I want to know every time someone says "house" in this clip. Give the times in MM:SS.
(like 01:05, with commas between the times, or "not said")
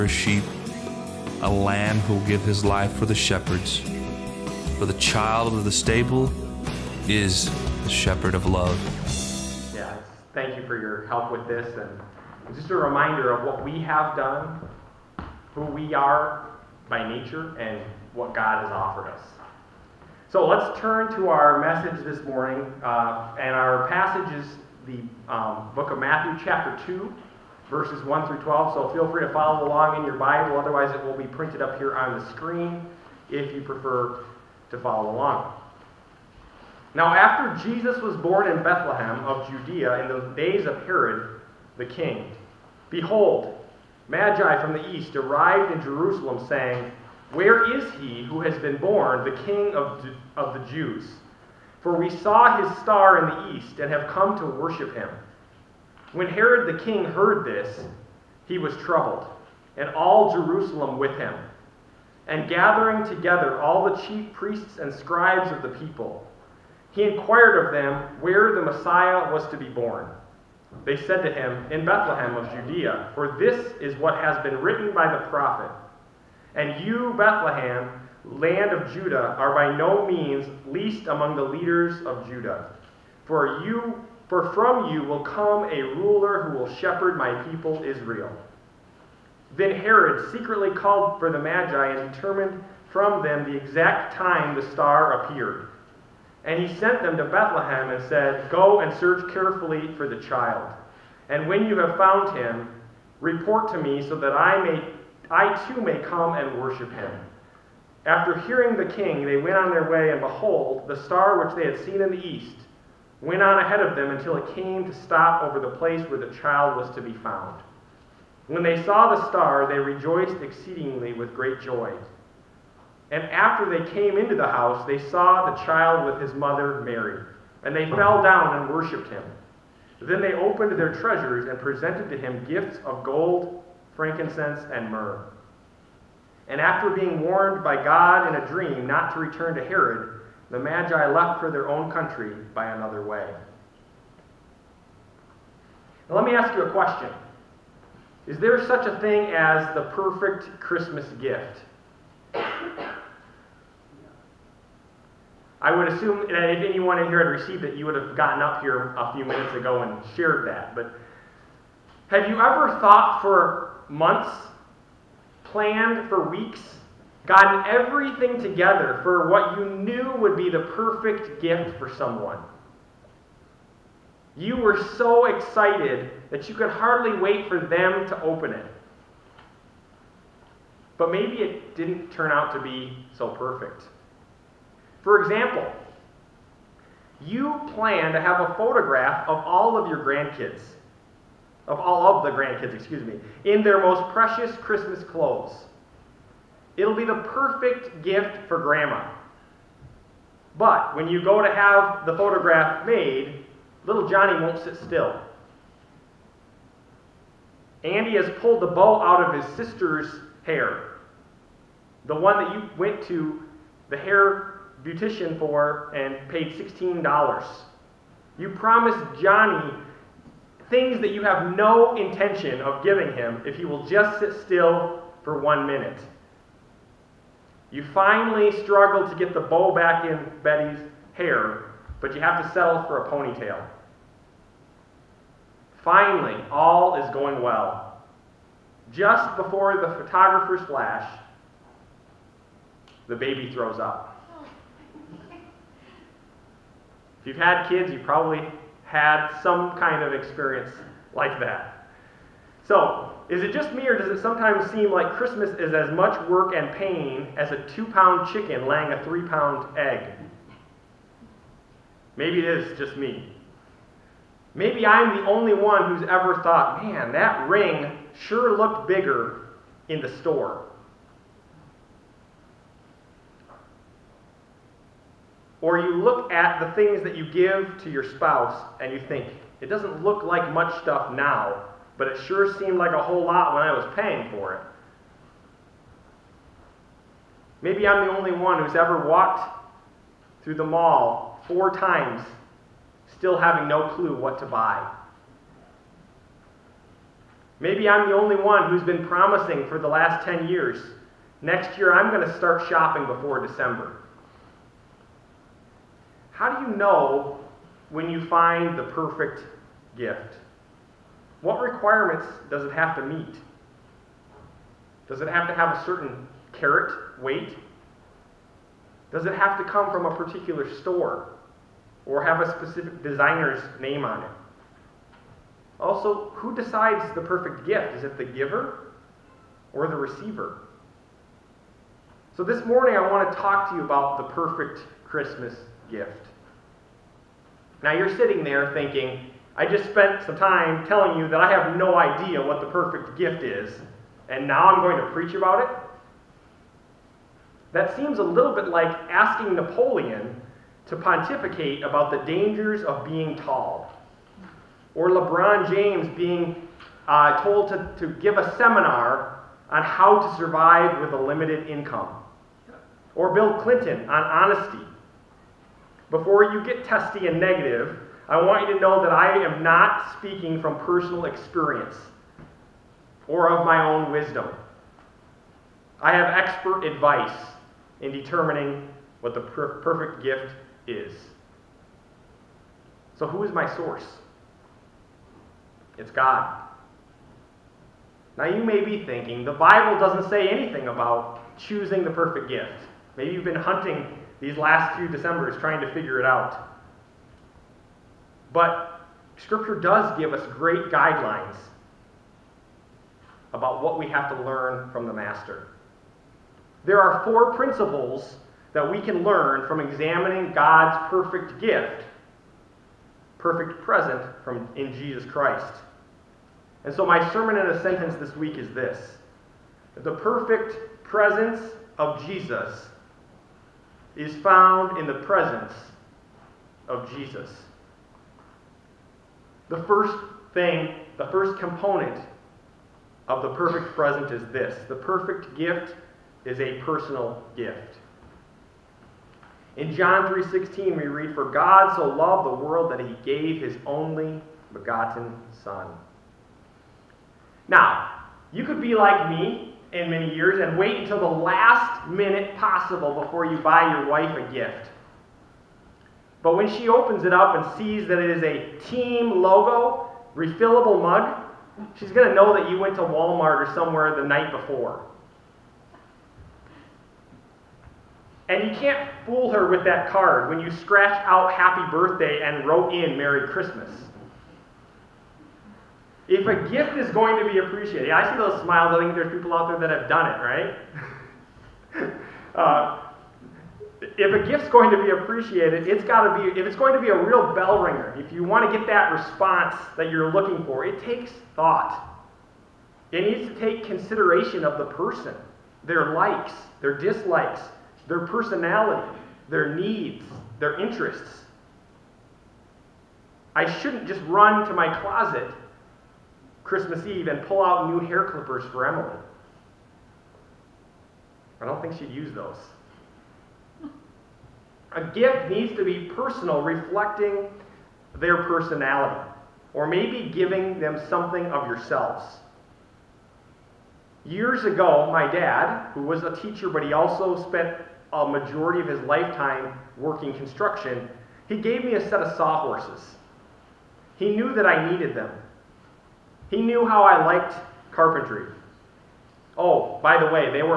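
02:04.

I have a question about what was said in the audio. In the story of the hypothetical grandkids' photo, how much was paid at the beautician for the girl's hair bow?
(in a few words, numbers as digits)
$16.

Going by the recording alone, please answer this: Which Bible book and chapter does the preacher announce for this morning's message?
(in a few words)
Matthew 2.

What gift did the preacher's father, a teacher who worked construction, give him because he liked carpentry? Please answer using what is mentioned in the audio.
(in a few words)
sawhorses.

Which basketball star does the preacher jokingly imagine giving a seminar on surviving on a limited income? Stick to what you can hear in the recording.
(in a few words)
LeBron James.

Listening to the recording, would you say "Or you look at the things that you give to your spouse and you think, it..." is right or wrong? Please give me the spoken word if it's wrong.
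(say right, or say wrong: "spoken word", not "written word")
right.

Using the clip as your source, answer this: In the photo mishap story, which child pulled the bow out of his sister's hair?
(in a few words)
Andy.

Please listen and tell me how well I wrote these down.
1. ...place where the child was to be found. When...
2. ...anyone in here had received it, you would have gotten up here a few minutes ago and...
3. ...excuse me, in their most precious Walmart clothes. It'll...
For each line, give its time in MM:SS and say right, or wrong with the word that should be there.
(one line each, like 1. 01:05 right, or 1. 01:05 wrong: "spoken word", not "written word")
1. 01:55 right
2. 02:36 right
3. 03:12 wrong: "Christmas", not "Walmart".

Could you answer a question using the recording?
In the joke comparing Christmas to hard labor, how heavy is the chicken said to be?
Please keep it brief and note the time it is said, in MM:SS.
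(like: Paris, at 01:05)
2 pounds, at 04:17.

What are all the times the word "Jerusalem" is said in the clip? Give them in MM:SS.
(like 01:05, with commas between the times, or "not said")
00:45, 01:00.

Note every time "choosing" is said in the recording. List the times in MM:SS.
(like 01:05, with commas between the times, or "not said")
06:31.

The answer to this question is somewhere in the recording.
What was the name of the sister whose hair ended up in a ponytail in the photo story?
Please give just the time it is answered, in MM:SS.
03:50.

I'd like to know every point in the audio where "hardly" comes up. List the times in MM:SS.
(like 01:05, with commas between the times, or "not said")
02:56.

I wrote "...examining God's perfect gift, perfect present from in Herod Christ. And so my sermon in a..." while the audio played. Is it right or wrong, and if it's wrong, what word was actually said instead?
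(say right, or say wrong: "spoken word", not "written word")
wrong: "Jesus", not "Herod".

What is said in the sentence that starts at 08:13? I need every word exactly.
It needs to take consideration of the person, their likes, their dislikes, their personality, their needs, their interests.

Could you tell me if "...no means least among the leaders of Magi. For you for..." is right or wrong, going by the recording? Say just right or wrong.
wrong.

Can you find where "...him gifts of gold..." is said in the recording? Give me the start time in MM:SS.
02:12.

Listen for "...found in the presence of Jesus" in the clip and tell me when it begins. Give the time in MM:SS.
07:04.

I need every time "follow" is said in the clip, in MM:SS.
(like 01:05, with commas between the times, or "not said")
00:29, 00:34.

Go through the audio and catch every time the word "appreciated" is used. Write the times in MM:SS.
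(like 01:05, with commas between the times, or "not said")
07:57, 08:05.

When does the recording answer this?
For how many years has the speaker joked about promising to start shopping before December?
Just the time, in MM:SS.
05:00.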